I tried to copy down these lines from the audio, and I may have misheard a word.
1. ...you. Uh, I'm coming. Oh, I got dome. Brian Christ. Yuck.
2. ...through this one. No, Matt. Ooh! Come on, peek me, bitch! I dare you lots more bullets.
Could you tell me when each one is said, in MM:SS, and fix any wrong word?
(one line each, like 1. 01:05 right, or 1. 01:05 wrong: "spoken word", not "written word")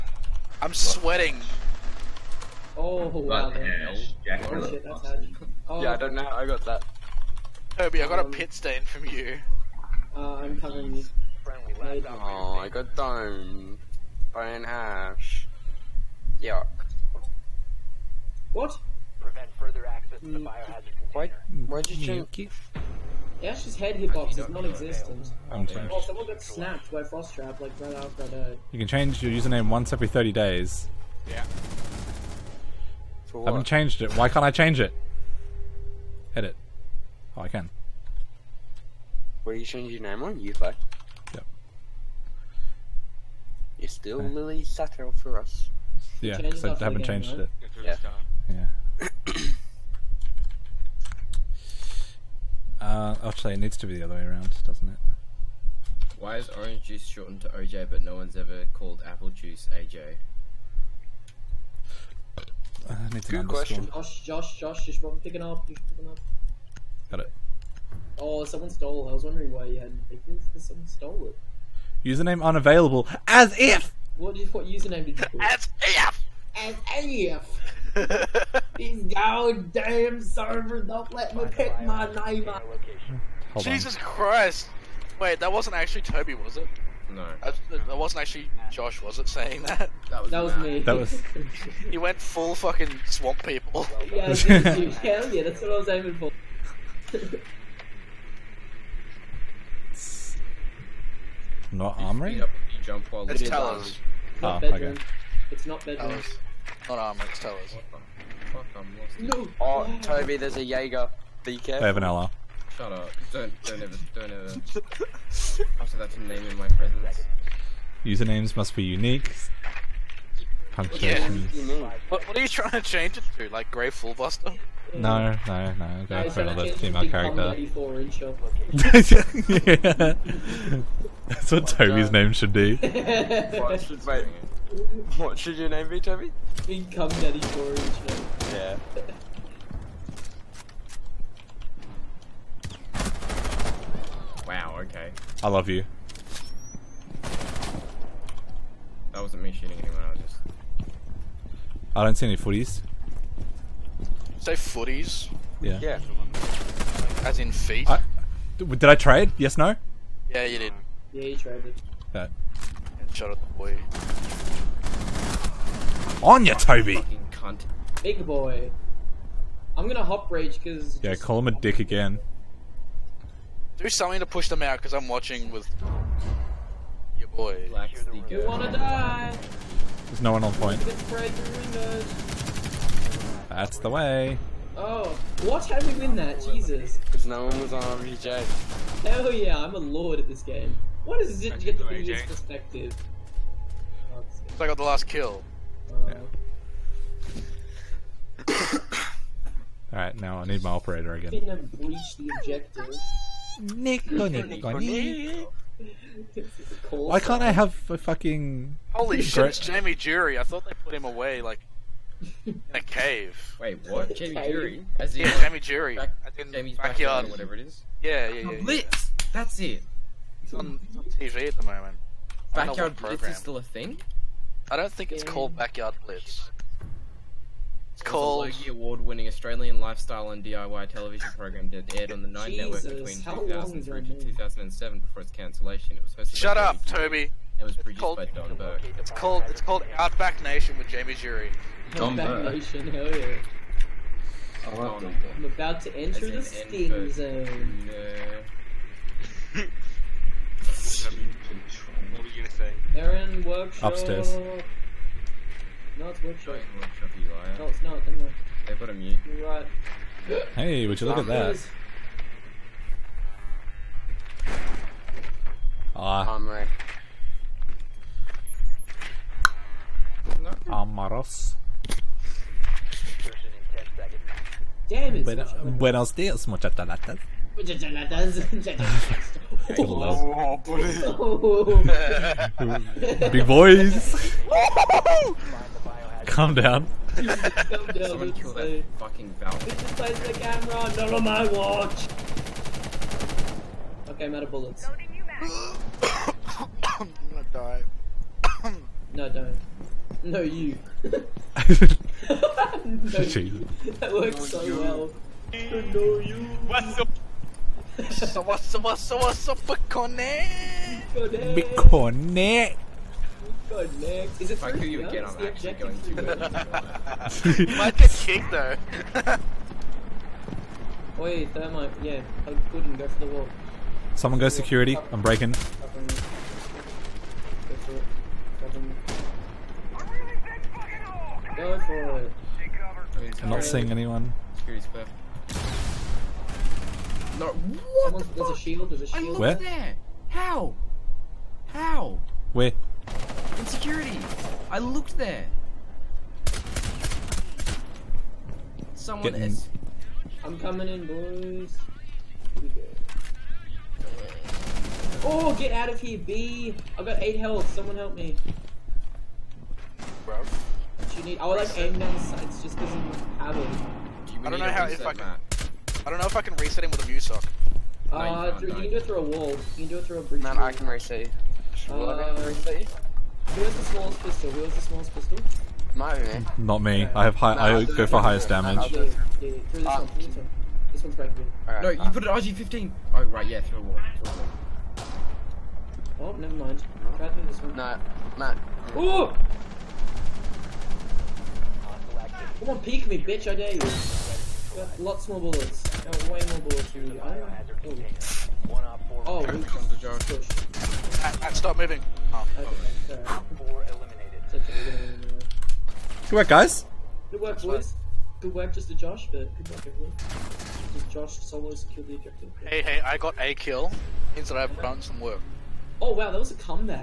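1. 00:09 wrong: "Hash", not "Christ"
2. 06:27 right.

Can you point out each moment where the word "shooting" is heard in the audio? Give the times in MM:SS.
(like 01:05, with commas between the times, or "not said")
02:29.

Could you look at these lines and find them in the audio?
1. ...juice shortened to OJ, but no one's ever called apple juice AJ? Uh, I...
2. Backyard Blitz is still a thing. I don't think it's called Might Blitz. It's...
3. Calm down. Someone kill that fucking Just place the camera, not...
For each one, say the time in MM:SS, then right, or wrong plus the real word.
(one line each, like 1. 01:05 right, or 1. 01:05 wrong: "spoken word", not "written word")
1. 00:56 right
2. 03:42 wrong: "Backyard", not "Might"
3. 04:46 right.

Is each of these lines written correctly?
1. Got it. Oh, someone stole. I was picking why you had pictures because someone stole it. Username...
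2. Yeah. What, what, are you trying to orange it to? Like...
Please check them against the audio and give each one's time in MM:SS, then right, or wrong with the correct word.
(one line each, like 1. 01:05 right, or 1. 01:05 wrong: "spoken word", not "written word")
1. 01:07 wrong: "wondering", not "picking"
2. 02:00 wrong: "change", not "orange".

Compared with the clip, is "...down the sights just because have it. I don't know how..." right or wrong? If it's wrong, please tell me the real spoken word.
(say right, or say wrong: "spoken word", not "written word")
right.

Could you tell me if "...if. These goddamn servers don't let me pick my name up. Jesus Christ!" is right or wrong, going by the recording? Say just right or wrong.
right.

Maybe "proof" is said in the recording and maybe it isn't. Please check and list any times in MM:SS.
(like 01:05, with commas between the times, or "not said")
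not said.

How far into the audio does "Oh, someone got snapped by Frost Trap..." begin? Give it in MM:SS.
00:25.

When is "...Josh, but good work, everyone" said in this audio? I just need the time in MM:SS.
06:48.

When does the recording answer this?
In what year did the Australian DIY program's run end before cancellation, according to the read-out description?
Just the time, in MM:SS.
03:54.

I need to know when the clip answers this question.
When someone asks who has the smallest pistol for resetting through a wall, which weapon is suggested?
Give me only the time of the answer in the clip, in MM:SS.
06:22.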